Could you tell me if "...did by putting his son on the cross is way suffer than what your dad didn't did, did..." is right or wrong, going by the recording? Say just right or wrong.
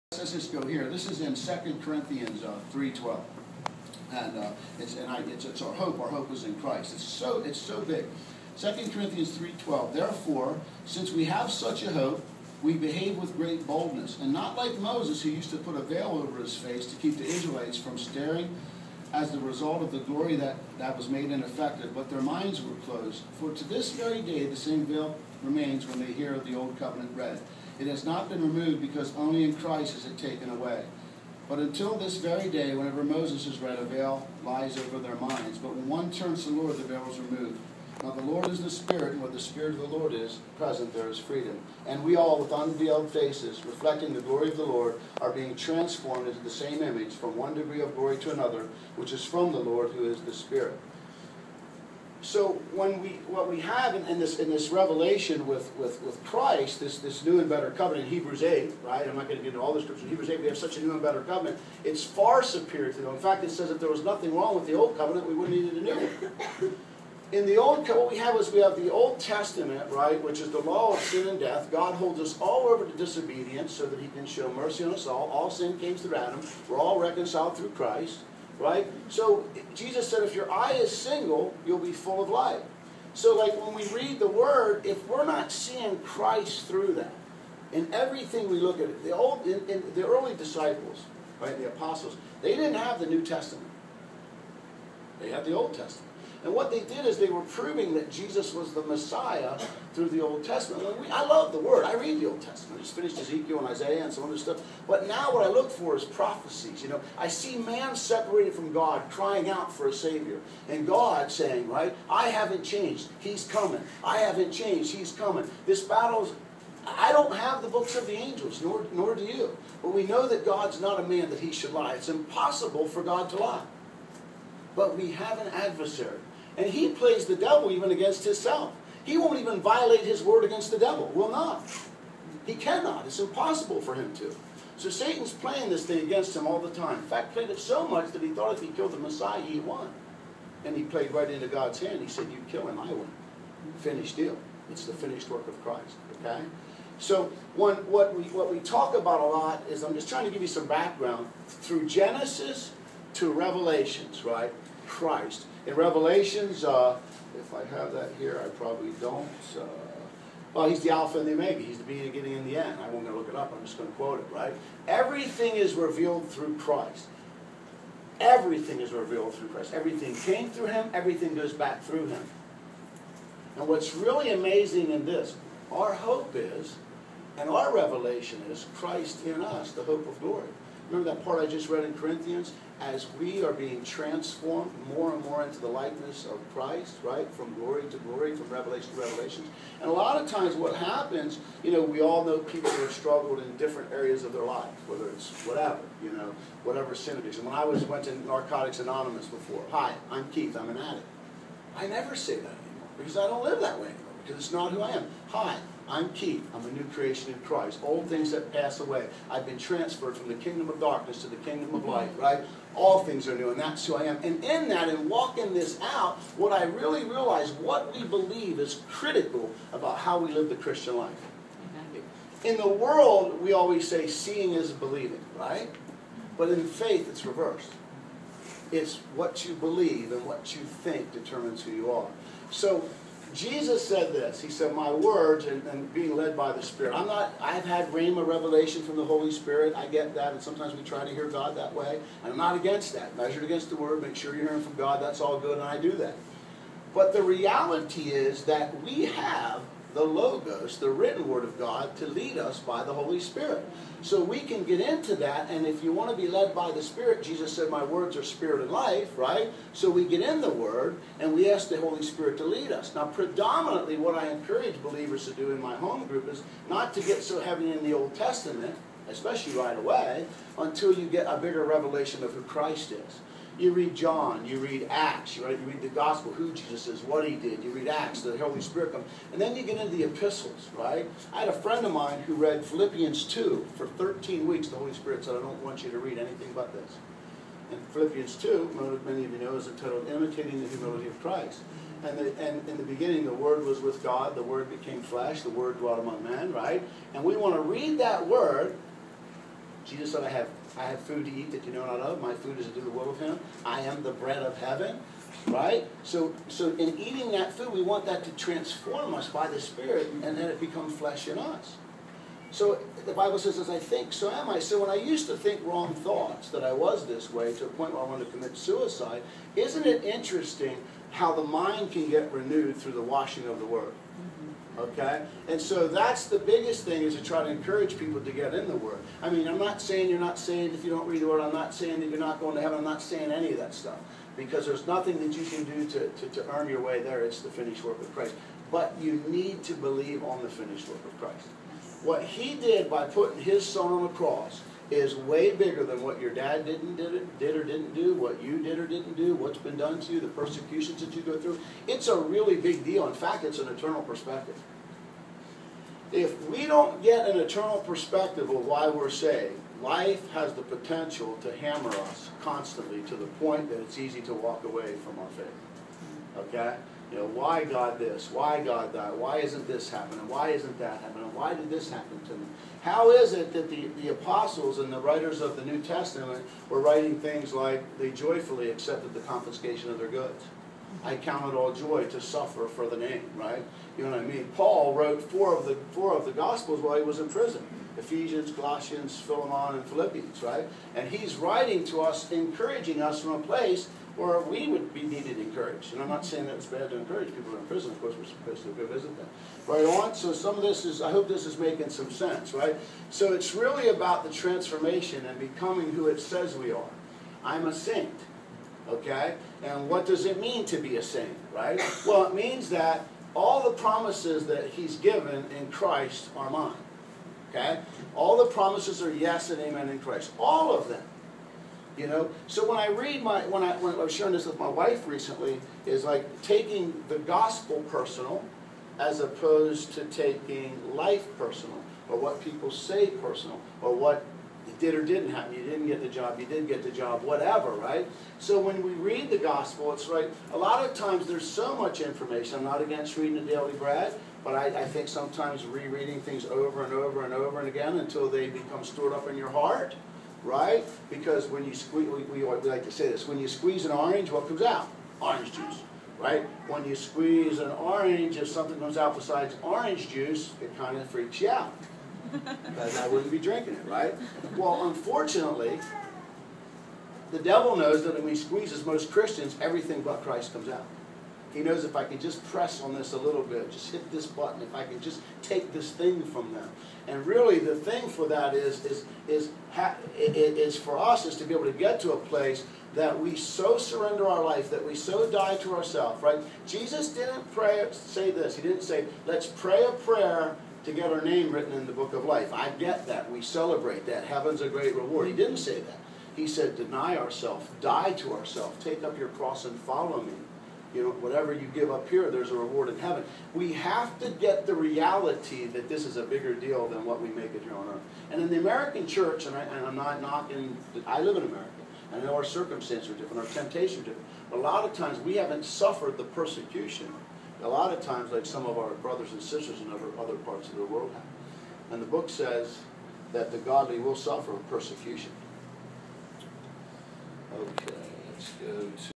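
wrong.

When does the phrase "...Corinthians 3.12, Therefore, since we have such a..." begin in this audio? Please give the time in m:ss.
0:08.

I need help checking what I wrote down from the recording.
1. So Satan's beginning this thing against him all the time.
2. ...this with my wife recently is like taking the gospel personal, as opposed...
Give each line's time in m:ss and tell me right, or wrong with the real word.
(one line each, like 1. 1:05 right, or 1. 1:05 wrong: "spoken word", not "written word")
1. 2:14 wrong: "playing", not "beginning"
2. 7:04 right.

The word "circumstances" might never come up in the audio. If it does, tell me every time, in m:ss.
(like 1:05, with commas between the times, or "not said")
8:32.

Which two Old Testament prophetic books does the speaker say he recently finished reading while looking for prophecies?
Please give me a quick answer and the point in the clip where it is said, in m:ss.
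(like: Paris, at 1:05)
Ezekiel and Isaiah, at 1:43.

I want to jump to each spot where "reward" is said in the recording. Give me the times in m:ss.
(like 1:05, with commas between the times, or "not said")
8:14, 8:22.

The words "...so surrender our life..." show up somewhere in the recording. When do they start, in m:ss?
8:03.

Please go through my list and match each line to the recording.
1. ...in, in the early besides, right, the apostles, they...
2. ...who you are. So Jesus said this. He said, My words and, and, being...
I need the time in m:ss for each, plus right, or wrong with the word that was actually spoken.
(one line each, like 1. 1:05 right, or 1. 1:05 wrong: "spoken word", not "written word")
1. 1:29 wrong: "disciples", not "besides"
2. 3:51 right.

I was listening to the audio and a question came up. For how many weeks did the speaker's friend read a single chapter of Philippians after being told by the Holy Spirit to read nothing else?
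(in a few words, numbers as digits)
13 weeks.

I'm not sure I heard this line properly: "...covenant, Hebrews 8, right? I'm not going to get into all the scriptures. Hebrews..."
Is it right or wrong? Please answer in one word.
right.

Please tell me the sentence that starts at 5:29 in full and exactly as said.
I mean, I'm not saying you're not saved if you don't read the Word.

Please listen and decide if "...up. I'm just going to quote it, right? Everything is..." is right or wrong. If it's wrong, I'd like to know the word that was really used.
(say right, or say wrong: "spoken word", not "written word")
right.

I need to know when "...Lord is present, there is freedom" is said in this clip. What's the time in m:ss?
0:39.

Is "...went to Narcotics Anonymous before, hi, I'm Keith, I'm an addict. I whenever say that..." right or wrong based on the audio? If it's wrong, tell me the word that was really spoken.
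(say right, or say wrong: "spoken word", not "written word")
wrong: "never", not "whenever".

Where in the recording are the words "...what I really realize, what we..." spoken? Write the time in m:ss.
3:36.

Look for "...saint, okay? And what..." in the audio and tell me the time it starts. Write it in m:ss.
6:47.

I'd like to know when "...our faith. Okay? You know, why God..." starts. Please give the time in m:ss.
6:05.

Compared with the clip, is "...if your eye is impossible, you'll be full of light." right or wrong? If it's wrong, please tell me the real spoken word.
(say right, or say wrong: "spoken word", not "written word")
wrong: "single", not "impossible".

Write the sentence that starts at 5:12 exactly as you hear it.
So the Bible says, as I think, so am I.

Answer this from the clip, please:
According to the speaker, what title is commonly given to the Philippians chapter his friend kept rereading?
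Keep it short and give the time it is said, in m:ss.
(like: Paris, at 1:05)
Imitating the Humility of Christ, at 4:50.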